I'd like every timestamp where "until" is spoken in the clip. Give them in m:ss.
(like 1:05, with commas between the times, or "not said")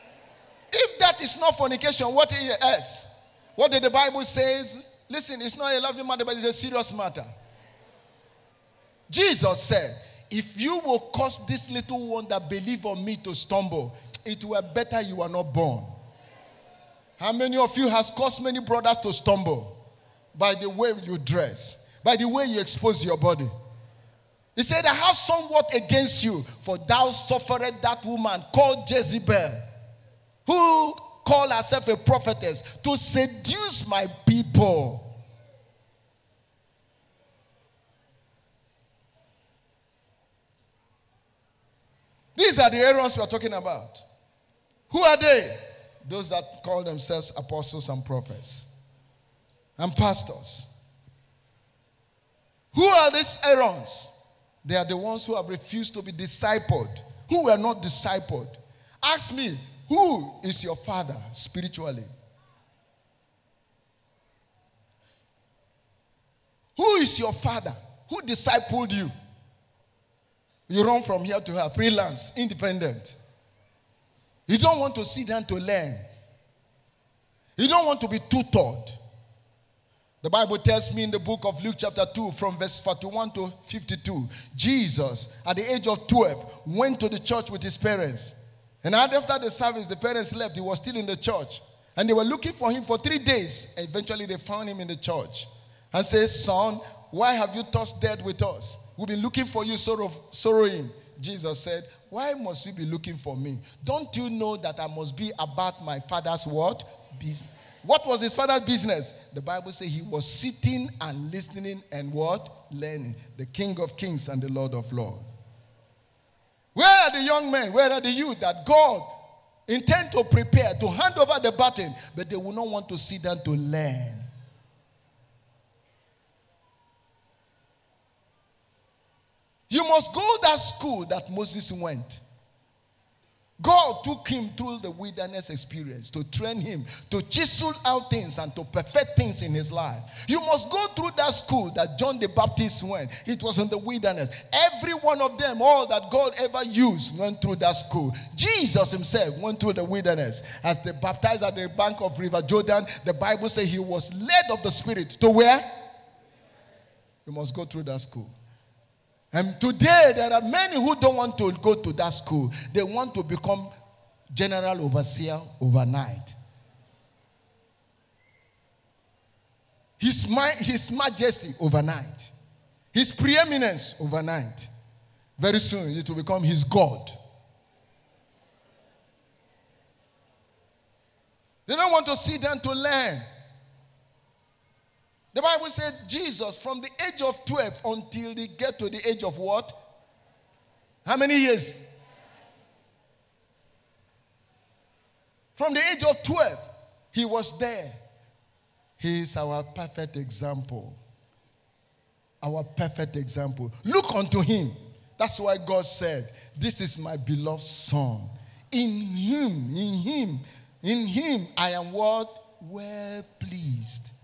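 3:07.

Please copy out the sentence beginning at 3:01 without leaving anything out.
They don't want to sit down to learn.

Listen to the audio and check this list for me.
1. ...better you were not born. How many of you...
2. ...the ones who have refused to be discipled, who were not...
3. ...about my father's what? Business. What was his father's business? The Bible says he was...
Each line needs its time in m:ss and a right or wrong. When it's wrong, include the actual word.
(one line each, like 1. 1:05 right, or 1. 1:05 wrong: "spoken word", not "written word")
1. 0:14 right
2. 0:54 right
3. 1:45 right.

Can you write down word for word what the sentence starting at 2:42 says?
They want to become general overseer overnight.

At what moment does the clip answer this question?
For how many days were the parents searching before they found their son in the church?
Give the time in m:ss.
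1:32.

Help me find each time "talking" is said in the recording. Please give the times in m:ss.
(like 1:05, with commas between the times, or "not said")
0:43.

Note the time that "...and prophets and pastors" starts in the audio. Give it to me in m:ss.
0:47.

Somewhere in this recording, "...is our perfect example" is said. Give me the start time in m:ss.
3:19.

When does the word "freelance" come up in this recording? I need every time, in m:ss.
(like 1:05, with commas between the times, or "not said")
1:11.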